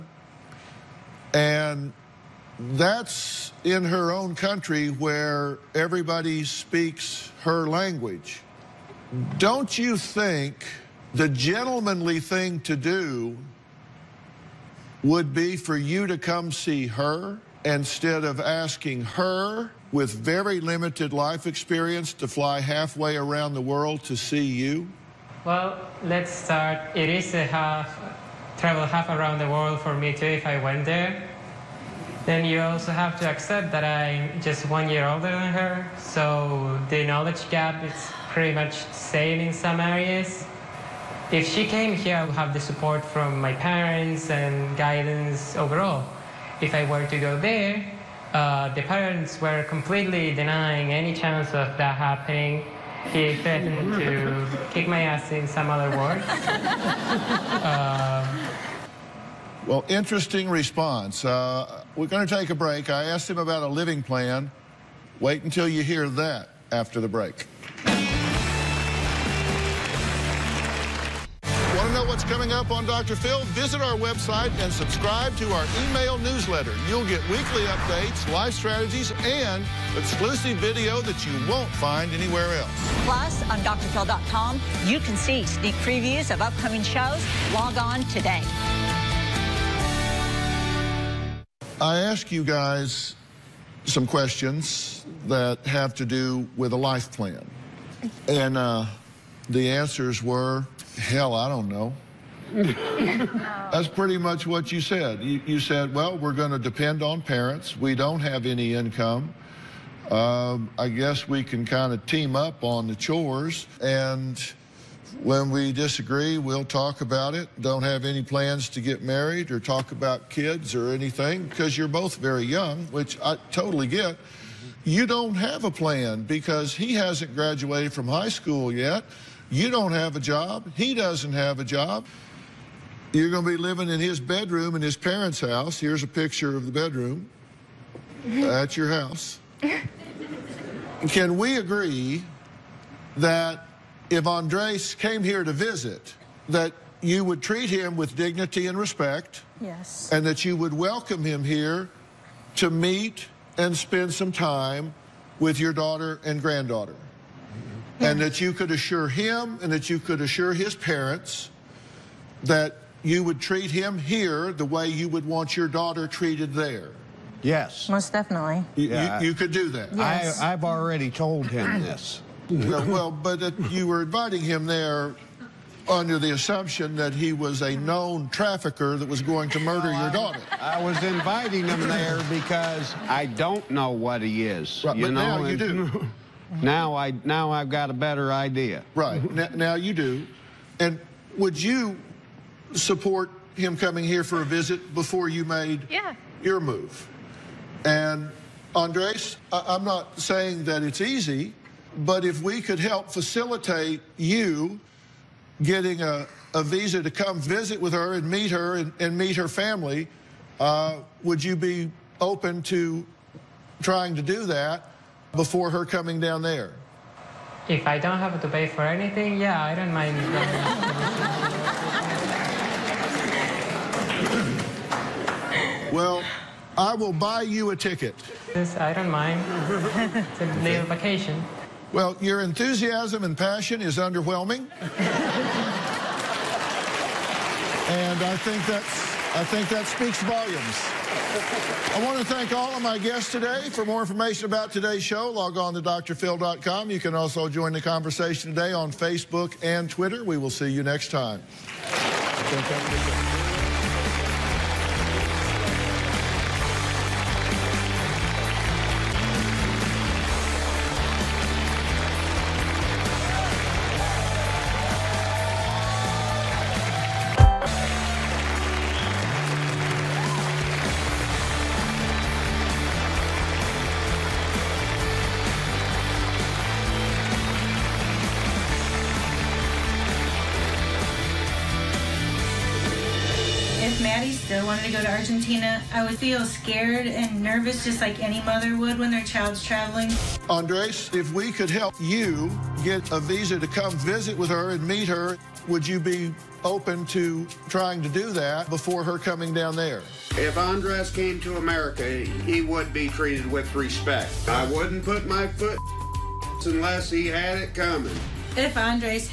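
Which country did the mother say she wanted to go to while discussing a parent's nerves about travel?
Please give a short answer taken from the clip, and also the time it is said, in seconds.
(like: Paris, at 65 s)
Argentina, at 285 s.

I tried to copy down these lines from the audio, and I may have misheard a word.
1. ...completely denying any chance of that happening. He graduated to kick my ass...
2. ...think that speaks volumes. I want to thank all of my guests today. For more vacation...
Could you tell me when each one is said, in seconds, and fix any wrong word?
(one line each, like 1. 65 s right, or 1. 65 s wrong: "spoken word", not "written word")
1. 49 s wrong: "threatened", not "graduated"
2. 239 s wrong: "information", not "vacation".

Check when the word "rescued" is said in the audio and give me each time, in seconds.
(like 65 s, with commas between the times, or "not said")
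not said.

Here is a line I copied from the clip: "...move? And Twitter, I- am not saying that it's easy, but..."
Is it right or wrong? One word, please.
wrong.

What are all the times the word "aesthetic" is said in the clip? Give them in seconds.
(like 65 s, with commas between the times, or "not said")
not said.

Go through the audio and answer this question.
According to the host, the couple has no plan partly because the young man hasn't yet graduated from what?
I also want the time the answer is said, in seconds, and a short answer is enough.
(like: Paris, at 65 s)
High school, at 128 s.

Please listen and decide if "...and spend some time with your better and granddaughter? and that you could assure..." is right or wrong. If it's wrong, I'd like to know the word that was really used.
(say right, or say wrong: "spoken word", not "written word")
wrong: "daughter", not "better".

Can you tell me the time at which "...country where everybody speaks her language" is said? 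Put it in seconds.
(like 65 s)
4 s.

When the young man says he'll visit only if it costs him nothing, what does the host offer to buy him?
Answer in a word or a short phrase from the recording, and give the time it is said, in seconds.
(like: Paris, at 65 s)
A ticket, at 227 s.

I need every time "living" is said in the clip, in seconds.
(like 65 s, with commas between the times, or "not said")
63 s, 133 s.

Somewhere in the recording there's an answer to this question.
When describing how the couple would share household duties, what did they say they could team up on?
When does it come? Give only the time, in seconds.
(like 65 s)
112 s.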